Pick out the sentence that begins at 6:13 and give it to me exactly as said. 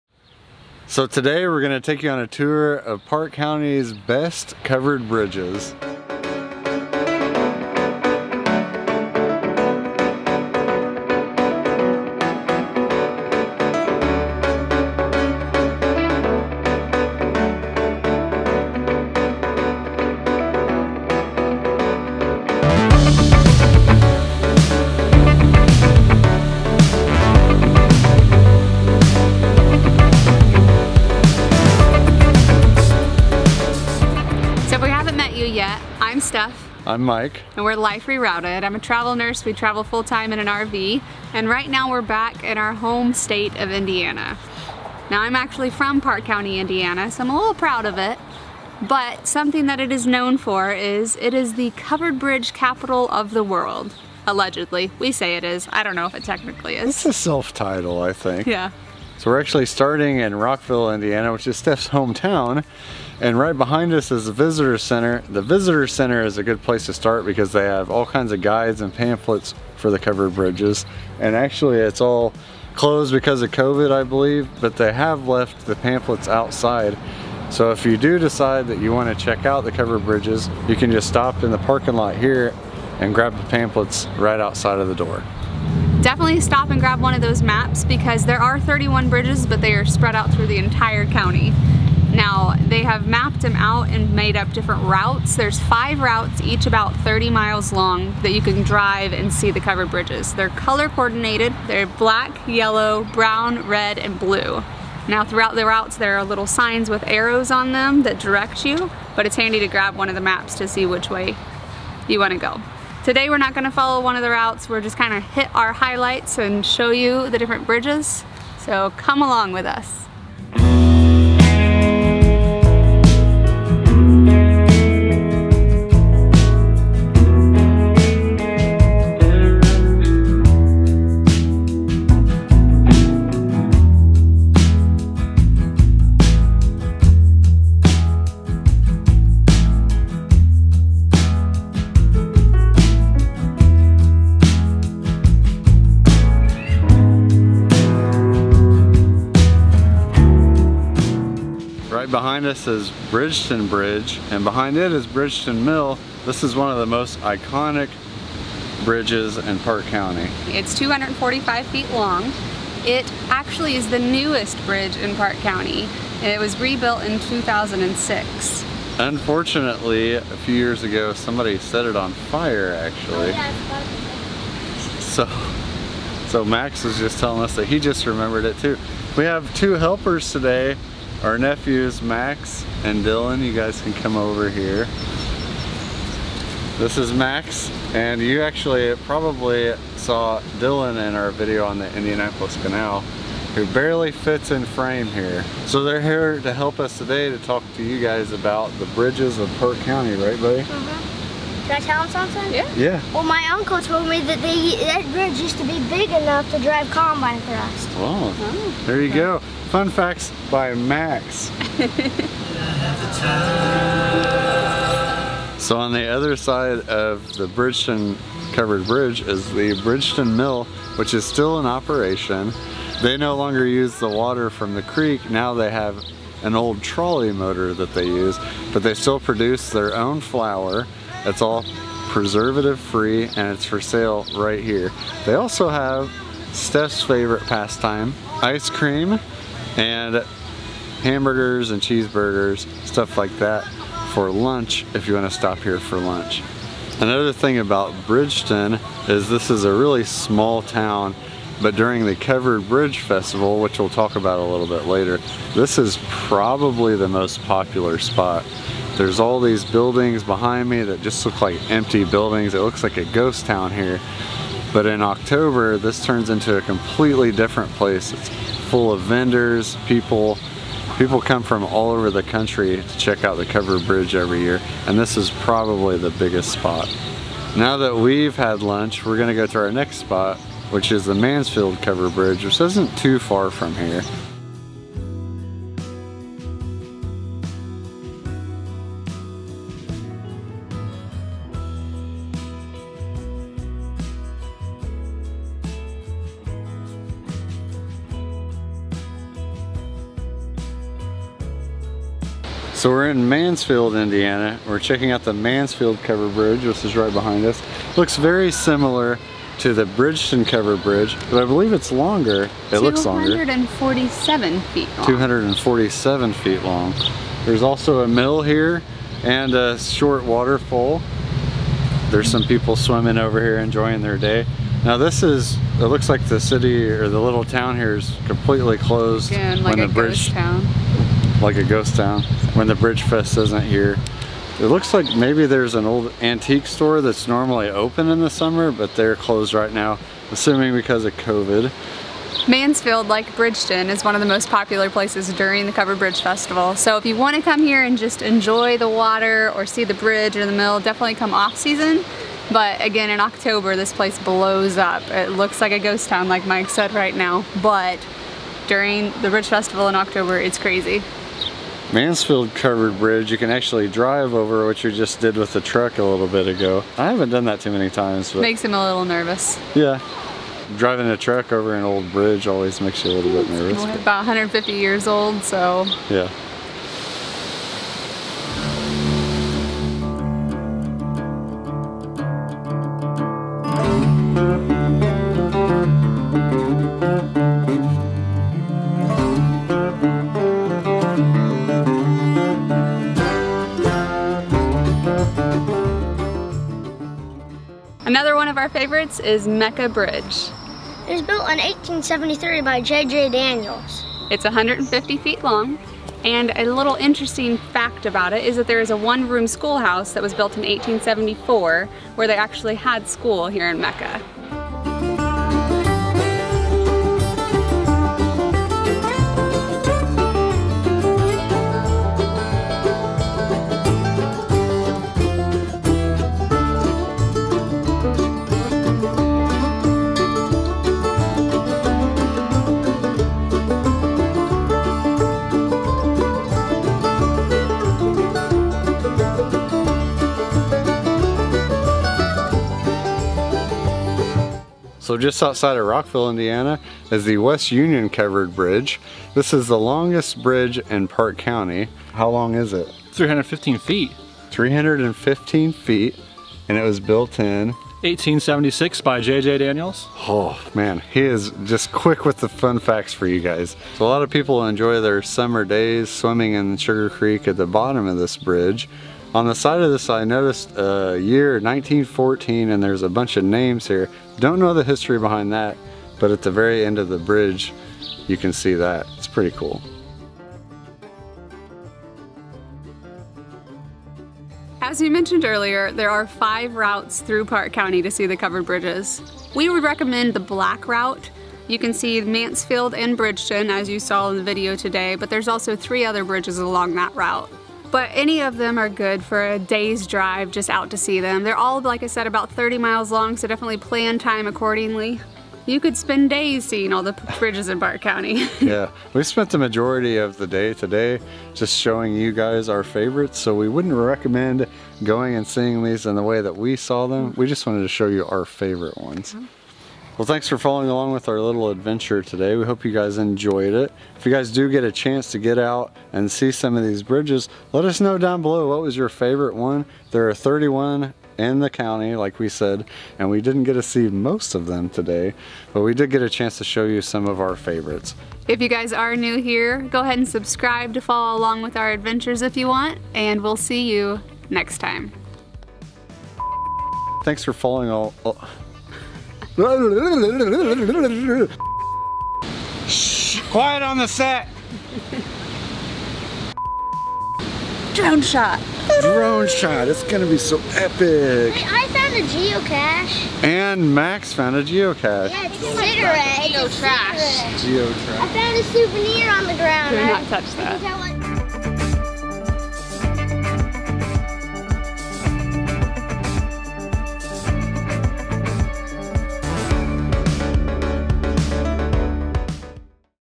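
it's about 150 years old, so.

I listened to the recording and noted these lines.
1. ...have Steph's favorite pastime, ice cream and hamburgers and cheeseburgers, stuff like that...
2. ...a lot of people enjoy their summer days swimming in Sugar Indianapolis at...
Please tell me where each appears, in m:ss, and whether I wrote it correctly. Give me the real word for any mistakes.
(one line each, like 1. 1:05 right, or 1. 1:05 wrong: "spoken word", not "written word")
1. 3:55 right
2. 7:44 wrong: "Creek", not "Indianapolis".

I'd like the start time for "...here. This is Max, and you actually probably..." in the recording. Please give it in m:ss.
3:04.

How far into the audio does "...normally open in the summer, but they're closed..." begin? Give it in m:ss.
5:37.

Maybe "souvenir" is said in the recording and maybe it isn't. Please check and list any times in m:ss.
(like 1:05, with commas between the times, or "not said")
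9:28.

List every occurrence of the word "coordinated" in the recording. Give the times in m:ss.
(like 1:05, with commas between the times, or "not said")
1:40.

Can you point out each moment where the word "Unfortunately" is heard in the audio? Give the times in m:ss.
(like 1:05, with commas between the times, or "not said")
2:48.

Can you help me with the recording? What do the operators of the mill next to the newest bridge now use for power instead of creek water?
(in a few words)
an old trolley motor.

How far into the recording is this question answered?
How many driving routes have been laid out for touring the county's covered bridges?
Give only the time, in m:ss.
1:35.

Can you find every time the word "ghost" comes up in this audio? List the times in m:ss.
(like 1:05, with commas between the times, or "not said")
4:23, 5:31, 5:55.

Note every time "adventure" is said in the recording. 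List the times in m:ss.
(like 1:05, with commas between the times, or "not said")
8:41, 9:01.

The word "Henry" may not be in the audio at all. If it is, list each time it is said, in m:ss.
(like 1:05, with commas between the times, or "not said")
not said.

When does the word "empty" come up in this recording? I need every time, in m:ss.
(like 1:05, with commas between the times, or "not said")
4:21.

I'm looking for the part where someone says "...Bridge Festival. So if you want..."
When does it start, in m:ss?
5:45.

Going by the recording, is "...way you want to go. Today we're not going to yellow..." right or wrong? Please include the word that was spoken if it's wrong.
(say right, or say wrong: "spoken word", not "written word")
wrong: "follow", not "yellow".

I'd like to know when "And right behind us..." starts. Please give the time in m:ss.
1:03.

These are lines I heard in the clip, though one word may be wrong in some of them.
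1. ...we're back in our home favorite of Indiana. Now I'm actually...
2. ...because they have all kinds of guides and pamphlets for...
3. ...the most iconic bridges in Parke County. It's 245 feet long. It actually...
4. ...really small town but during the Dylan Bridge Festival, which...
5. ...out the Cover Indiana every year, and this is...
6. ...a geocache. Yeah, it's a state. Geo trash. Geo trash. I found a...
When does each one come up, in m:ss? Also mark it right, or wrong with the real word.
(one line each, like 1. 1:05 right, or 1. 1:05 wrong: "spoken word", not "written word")
1. 0:41 wrong: "state", not "favorite"
2. 1:07 right
3. 2:36 right
4. 4:09 wrong: "Covered", not "Dylan"
5. 4:33 wrong: "Bridge", not "Indiana"
6. 9:24 wrong: "cigarette", not "state".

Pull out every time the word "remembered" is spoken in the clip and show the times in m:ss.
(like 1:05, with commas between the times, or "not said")
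2:58.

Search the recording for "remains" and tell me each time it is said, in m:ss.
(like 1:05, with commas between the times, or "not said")
not said.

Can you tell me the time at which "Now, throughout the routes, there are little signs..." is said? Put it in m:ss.
1:45.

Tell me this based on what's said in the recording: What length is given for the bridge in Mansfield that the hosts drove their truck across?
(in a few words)
247 feet.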